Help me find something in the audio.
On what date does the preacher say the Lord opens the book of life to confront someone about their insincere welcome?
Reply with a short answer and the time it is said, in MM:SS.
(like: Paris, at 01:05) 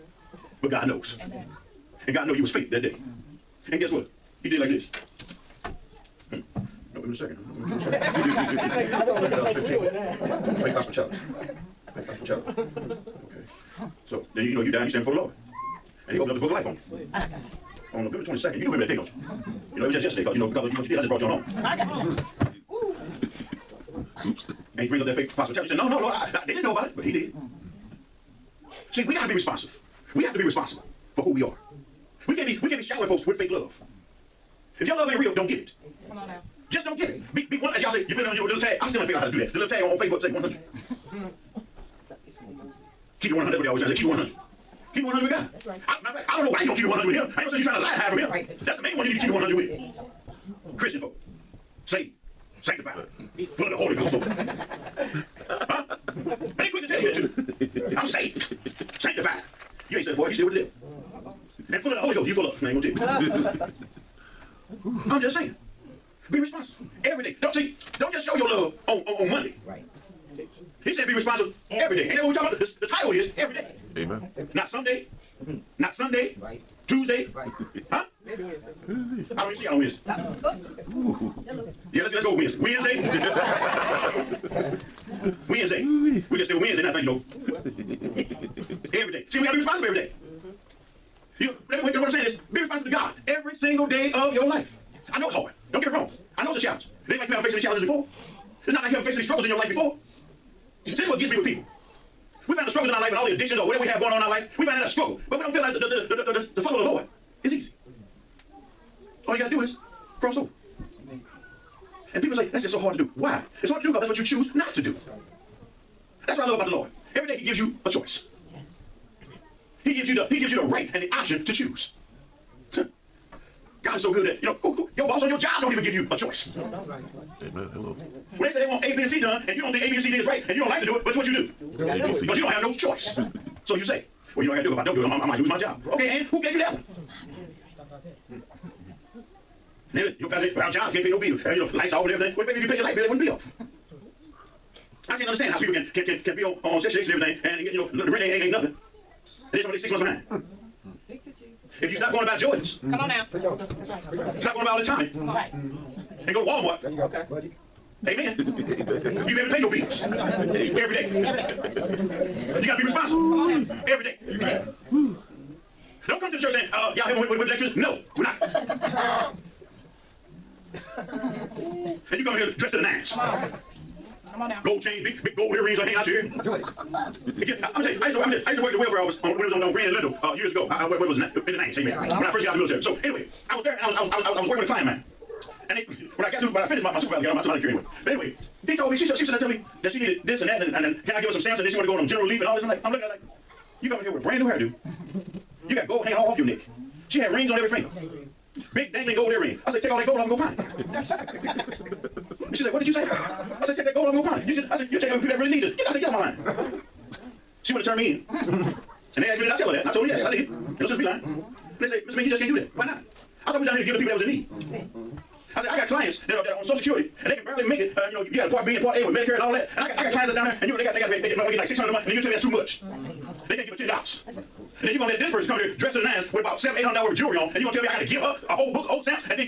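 November 22nd, at 00:18.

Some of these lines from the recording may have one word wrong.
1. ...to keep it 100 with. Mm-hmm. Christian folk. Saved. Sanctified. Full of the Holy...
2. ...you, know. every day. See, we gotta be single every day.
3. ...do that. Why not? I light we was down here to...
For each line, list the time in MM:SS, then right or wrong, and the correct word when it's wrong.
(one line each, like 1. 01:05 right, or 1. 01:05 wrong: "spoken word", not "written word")
1. 00:49 right
2. 01:27 wrong: "responsible", not "single"
3. 03:32 wrong: "thought", not "light".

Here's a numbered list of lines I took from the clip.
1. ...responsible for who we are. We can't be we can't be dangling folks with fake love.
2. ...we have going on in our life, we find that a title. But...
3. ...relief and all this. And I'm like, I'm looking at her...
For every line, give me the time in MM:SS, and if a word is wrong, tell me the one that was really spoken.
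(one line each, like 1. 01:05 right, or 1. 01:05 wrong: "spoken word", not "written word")
1. 00:30 wrong: "showering", not "dangling"
2. 01:43 wrong: "struggle", not "title"
3. 03:12 right.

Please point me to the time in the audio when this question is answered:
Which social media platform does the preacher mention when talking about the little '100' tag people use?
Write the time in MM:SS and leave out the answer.
00:39.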